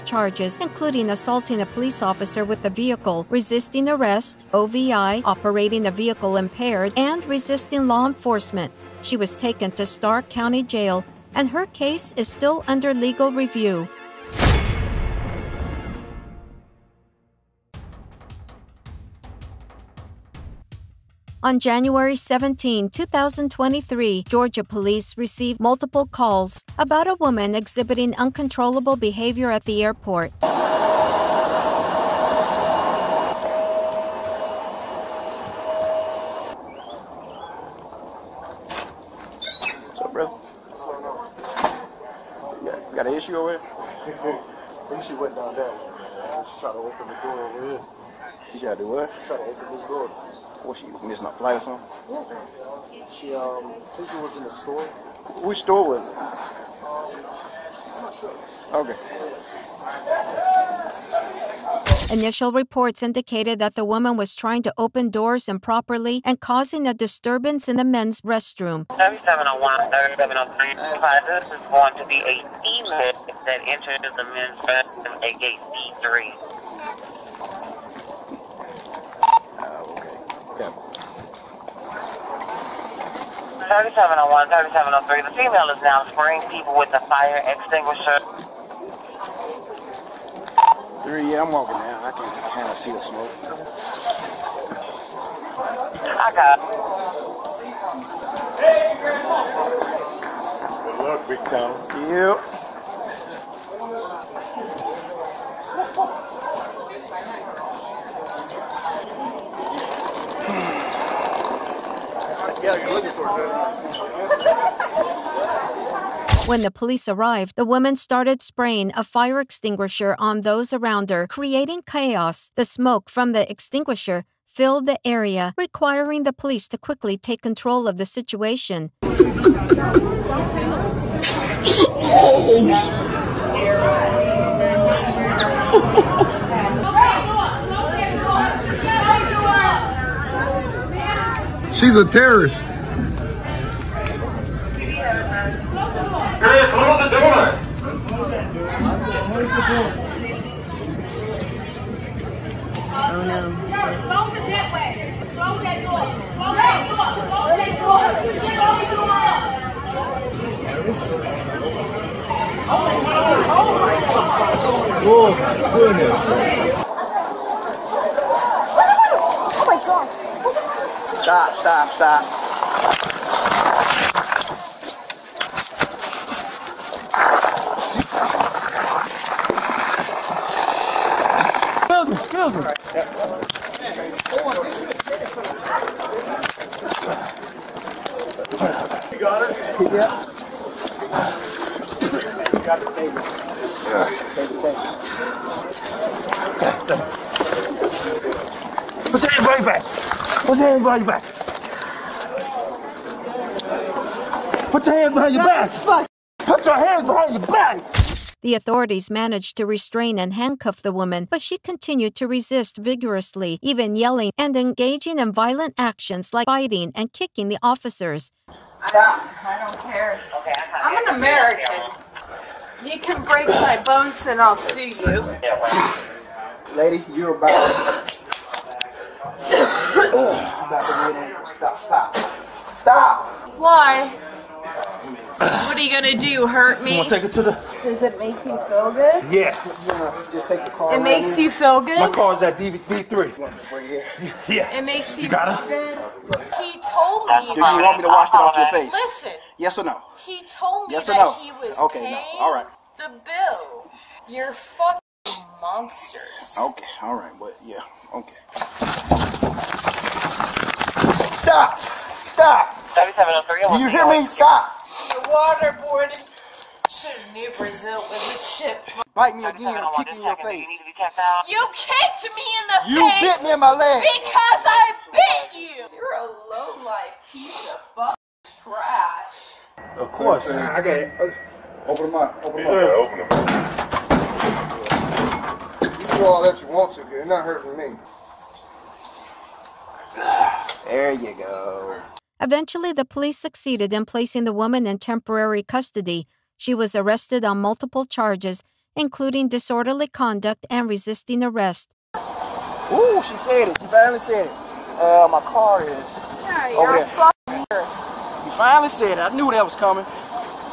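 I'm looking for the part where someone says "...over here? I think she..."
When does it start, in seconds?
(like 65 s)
43 s.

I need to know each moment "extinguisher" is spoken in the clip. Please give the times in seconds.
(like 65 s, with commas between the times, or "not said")
87 s, 119 s, 123 s.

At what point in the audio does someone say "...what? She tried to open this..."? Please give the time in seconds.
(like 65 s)
48 s.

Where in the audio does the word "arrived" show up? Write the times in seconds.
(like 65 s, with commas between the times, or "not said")
117 s.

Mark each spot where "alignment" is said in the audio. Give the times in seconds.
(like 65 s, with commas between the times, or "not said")
not said.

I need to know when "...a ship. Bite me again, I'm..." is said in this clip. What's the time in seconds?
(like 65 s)
268 s.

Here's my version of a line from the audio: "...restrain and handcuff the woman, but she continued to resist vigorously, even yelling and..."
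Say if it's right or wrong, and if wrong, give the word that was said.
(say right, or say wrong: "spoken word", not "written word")
right.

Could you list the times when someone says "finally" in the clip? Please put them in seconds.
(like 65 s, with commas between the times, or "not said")
303 s, 308 s.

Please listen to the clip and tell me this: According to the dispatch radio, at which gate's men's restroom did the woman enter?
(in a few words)
D3.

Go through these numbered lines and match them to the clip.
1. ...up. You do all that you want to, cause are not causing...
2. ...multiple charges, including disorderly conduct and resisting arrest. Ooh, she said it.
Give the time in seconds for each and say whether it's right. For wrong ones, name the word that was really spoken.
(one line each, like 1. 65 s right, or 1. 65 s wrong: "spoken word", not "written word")
1. 283 s wrong: "hurting", not "causing"
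2. 297 s right.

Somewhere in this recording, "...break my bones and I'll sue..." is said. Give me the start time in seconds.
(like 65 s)
223 s.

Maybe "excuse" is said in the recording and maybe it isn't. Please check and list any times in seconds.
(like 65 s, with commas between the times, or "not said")
182 s, 188 s.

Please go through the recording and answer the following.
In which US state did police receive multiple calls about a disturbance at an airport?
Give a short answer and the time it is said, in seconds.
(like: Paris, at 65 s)
Georgia, at 24 s.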